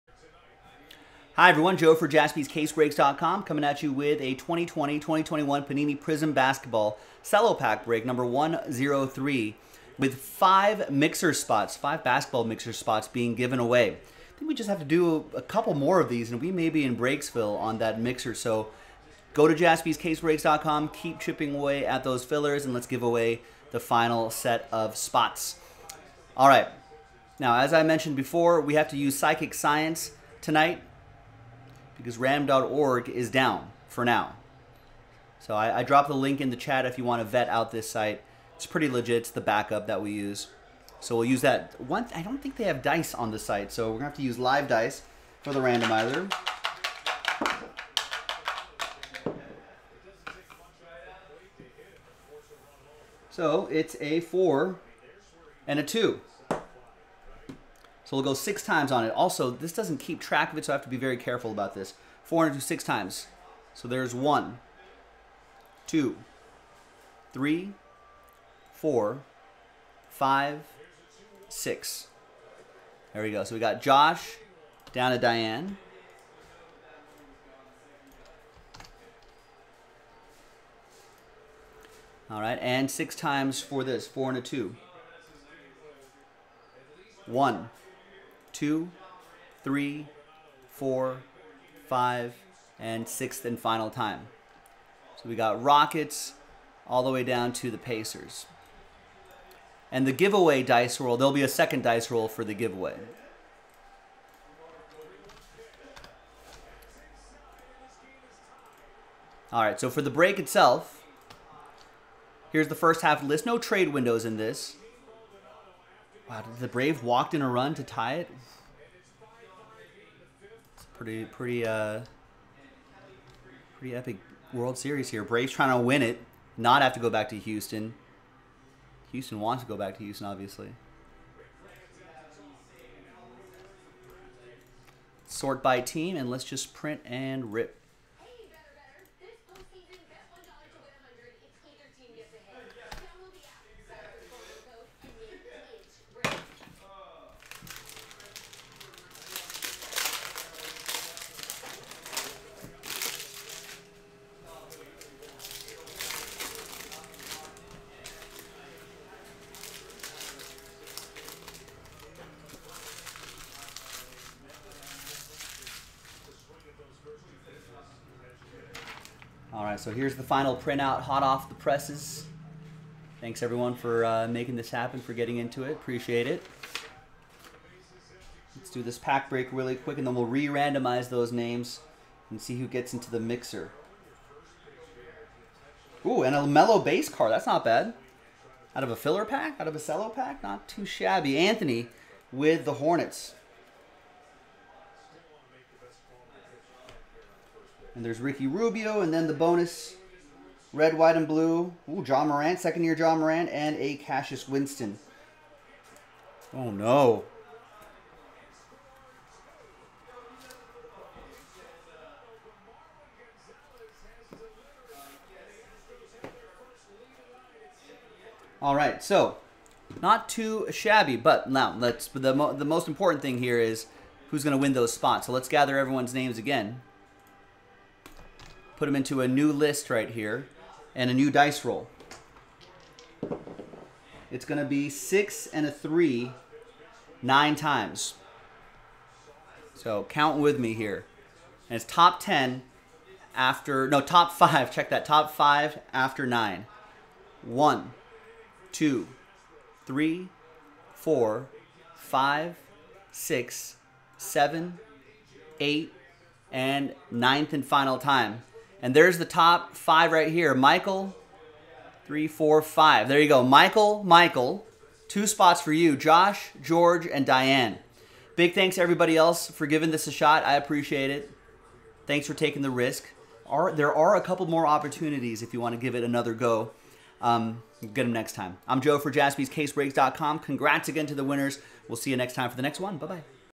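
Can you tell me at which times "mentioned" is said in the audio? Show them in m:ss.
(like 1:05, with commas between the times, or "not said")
0:27.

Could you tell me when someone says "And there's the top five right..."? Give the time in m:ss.
4:18.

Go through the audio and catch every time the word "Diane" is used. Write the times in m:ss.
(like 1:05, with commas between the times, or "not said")
1:15, 4:27.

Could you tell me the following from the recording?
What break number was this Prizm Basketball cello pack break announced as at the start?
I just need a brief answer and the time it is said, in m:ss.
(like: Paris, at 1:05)
103, at 0:08.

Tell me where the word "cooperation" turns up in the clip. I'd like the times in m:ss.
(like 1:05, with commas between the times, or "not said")
not said.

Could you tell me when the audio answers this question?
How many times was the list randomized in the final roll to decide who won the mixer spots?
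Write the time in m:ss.
3:57.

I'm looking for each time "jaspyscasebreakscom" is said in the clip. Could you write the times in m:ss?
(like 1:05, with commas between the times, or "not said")
0:02, 0:19, 4:39.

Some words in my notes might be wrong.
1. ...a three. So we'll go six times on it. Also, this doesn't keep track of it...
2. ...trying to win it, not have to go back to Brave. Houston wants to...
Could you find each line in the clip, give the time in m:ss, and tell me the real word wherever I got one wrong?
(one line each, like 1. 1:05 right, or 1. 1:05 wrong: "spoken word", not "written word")
1. 0:55 wrong: "two", not "three"
2. 2:05 wrong: "Houston", not "Brave".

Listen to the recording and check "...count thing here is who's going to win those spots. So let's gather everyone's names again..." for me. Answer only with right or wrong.
wrong.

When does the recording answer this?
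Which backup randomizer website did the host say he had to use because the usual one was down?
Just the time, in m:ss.
0:29.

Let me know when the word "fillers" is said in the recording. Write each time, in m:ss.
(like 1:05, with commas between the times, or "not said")
0:22, 3:08.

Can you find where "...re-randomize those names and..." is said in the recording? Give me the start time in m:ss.
3:00.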